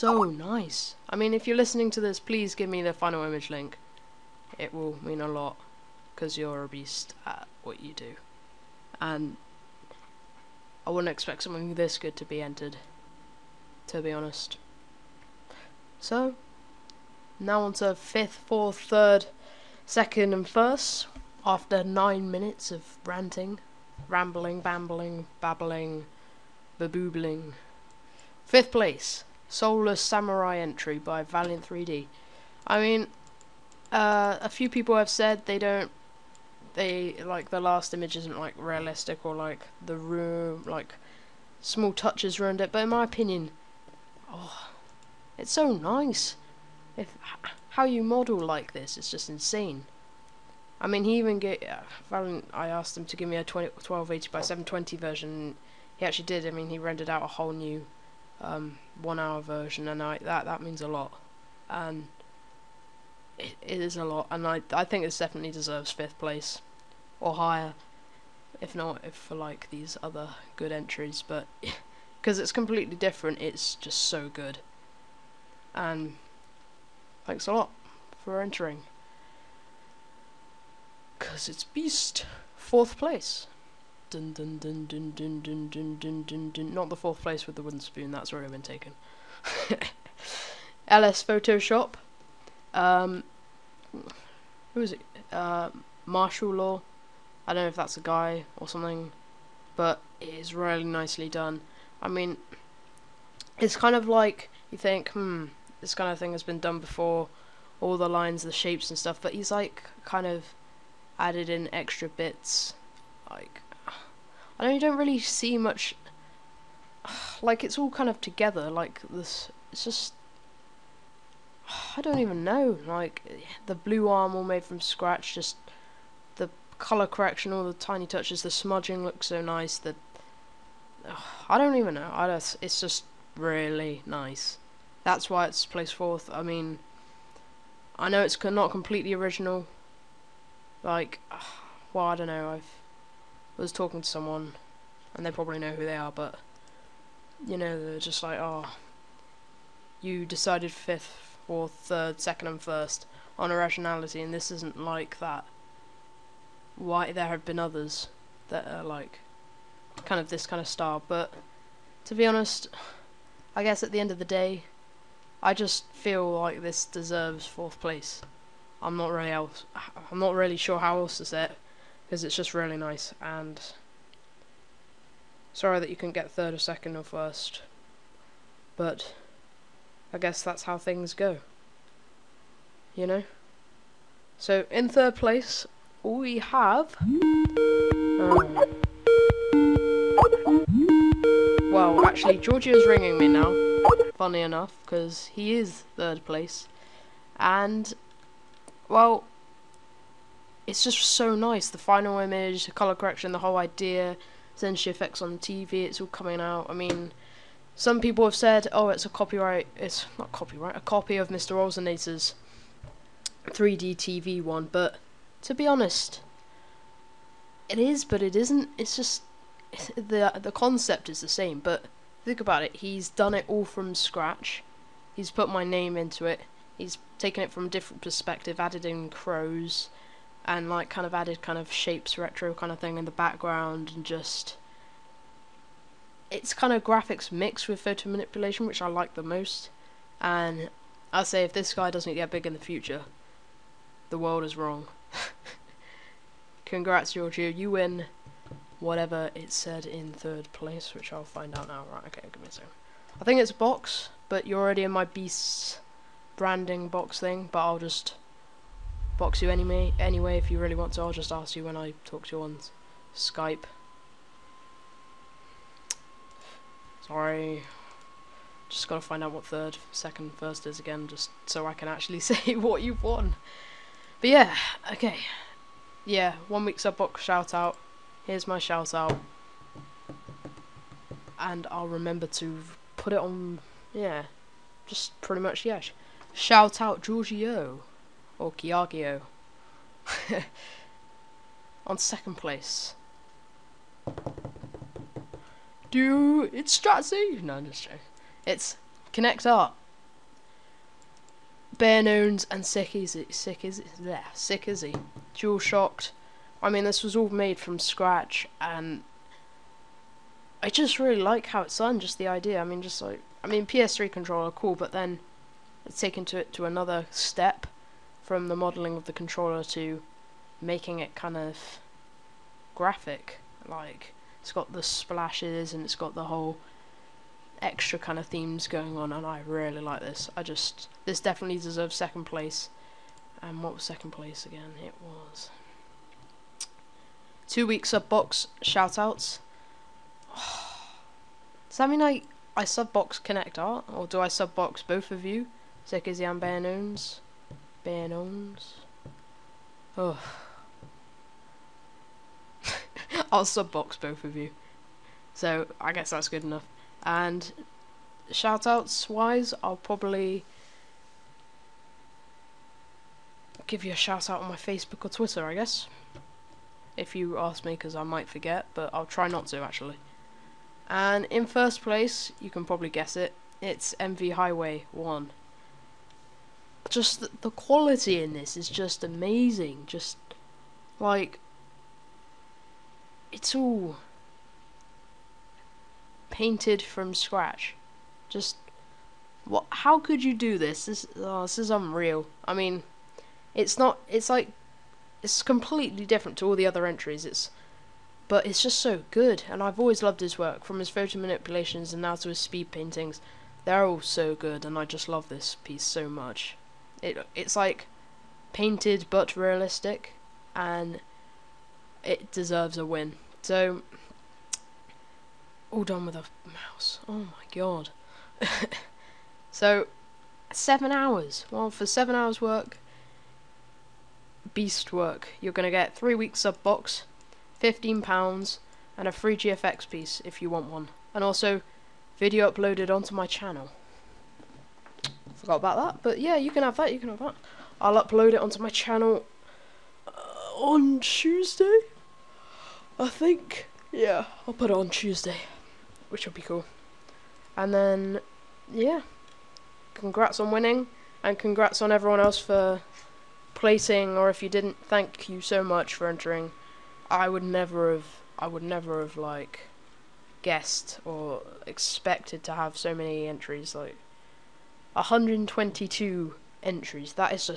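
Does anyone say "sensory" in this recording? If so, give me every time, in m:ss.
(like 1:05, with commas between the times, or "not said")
3:24.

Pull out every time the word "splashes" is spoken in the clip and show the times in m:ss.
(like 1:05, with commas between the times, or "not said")
5:24.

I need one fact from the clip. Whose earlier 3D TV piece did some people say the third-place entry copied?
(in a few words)
Mr. Olsenator.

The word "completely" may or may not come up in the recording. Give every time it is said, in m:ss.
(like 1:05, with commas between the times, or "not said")
1:12, 2:18, 6:35.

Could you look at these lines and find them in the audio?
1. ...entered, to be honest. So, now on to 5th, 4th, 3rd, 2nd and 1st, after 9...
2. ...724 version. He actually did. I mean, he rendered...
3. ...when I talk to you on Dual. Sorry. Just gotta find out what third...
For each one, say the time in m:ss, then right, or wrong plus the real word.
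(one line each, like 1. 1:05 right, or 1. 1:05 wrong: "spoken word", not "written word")
1. 0:12 right
2. 0:54 wrong: "720", not "724"
3. 4:21 wrong: "Skype", not "Dual".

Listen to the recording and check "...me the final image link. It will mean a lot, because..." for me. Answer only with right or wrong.
right.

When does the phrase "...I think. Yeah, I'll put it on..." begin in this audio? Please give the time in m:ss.
7:22.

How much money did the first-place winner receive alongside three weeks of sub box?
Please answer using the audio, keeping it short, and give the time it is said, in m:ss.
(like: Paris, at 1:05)
15 pounds, at 7:07.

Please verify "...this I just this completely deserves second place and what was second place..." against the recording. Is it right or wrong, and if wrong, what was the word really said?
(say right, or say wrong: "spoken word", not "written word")
wrong: "definitely", not "completely".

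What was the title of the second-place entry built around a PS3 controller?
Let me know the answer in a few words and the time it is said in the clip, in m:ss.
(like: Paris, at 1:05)
Dual Shocked, at 5:05.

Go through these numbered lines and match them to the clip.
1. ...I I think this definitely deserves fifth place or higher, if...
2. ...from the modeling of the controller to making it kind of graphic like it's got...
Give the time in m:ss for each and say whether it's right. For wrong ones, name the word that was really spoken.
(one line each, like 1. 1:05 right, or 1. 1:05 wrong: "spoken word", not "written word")
1. 1:04 right
2. 5:18 right.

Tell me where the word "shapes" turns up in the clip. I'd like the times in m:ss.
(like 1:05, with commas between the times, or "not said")
1:48, 3:51.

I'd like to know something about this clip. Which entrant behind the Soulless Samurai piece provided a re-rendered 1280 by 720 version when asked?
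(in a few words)
Valiant 3D.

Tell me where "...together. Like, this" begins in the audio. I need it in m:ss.
1:58.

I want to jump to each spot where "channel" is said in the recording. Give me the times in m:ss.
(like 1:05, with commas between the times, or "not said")
7:13, 7:18.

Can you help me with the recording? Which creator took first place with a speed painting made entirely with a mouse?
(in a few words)
MV Highway 1.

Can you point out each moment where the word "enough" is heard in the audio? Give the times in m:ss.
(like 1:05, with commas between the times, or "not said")
3:14, 5:56.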